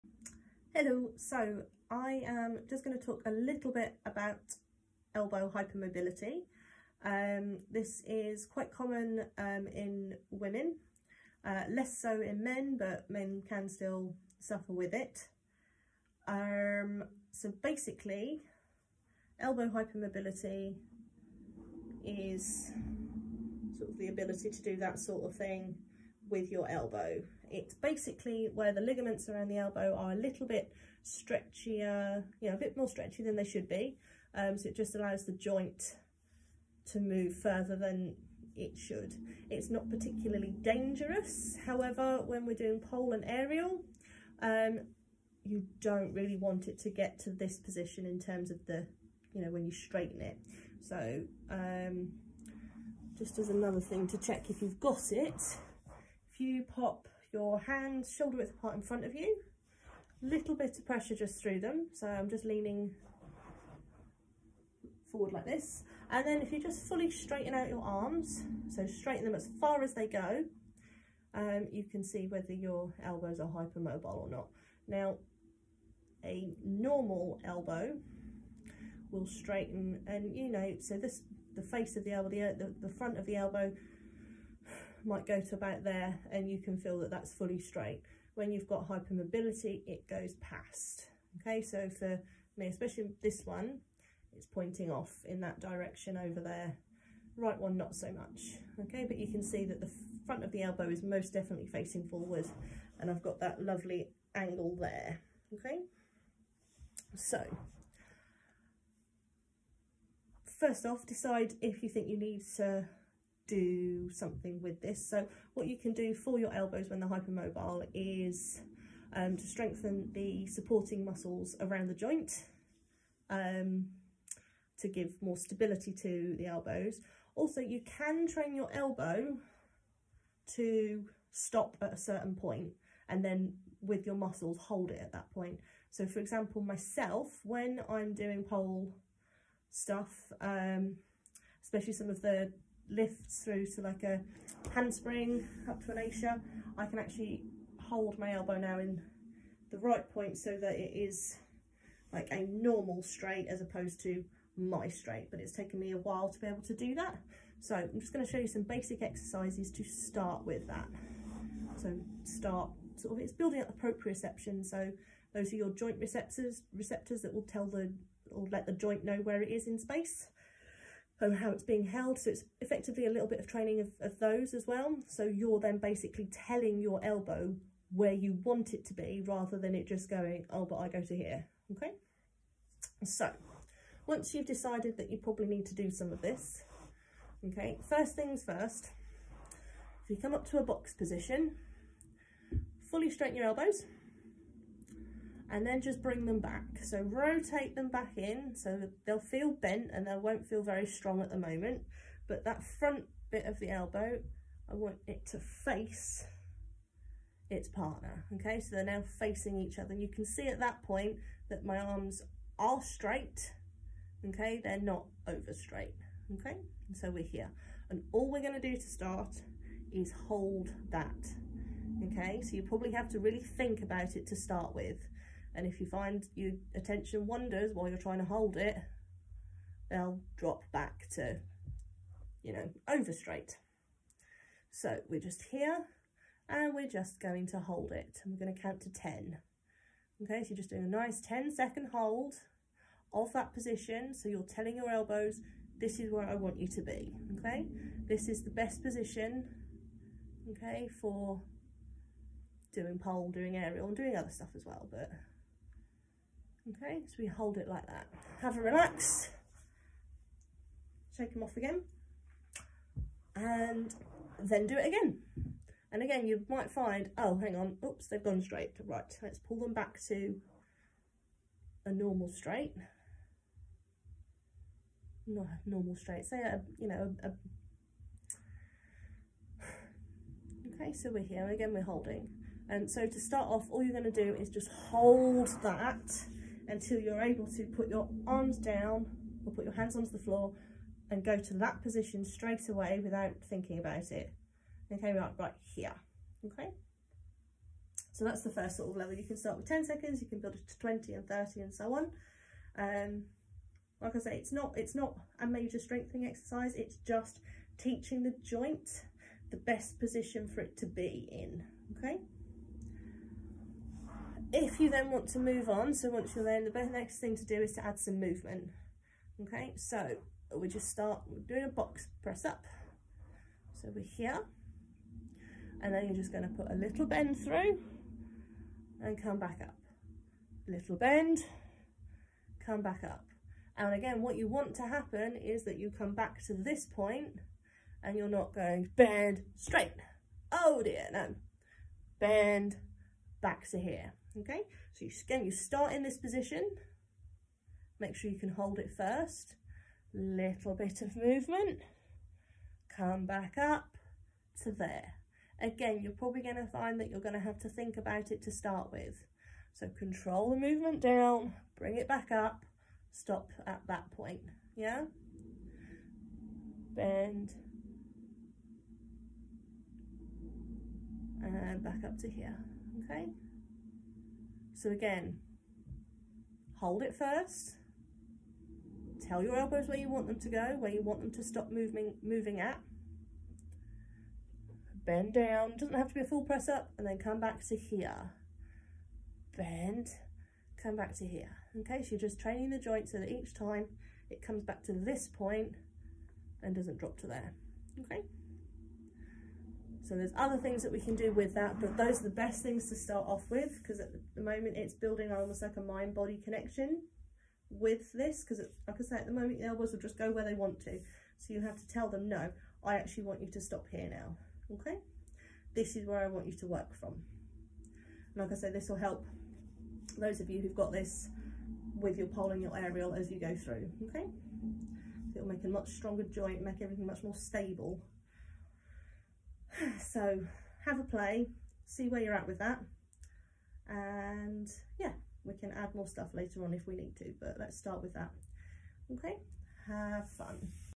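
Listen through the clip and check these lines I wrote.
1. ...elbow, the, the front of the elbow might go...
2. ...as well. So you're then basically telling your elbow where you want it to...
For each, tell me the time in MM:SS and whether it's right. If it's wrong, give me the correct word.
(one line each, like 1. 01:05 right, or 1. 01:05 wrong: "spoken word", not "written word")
1. 01:22 right
2. 02:54 right.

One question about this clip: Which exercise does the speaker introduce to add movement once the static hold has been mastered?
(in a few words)
Box press up.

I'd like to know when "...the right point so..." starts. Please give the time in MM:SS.
02:29.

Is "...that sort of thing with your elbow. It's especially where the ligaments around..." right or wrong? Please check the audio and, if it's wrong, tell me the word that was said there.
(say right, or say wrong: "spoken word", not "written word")
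wrong: "basically", not "especially".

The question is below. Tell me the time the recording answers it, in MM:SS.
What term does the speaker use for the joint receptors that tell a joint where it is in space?
02:43.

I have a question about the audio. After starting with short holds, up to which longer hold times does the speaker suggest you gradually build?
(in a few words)
20 and 30 seconds.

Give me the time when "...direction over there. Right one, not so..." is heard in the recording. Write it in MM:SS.
01:35.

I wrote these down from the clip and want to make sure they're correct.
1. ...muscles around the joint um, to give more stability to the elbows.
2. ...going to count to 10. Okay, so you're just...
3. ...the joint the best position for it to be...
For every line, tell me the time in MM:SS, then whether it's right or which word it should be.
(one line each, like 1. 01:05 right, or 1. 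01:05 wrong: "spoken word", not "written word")
1. 02:01 right
2. 03:58 right
3. 05:08 right.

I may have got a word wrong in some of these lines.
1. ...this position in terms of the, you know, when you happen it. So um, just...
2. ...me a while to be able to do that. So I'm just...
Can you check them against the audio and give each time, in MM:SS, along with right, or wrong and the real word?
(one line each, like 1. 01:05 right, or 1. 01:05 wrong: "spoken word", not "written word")
1. 00:47 wrong: "straighten", not "happen"
2. 02:35 right.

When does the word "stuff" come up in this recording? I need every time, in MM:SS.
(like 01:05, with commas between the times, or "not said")
02:19, 04:14, 07:16.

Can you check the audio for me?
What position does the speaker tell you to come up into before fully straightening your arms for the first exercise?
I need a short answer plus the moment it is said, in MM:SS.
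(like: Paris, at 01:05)
Box position, at 03:10.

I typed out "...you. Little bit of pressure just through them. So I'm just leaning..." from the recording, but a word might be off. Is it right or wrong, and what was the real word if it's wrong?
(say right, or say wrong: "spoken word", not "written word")
right.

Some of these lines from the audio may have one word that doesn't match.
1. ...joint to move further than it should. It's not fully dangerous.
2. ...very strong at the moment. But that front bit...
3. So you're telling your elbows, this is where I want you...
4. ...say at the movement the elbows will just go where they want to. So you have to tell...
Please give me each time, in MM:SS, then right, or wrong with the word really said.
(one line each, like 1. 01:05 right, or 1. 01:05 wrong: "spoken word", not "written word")
1. 00:35 wrong: "particularly", not "fully"
2. 03:20 right
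3. 04:04 right
4. 06:49 wrong: "moment", not "movement".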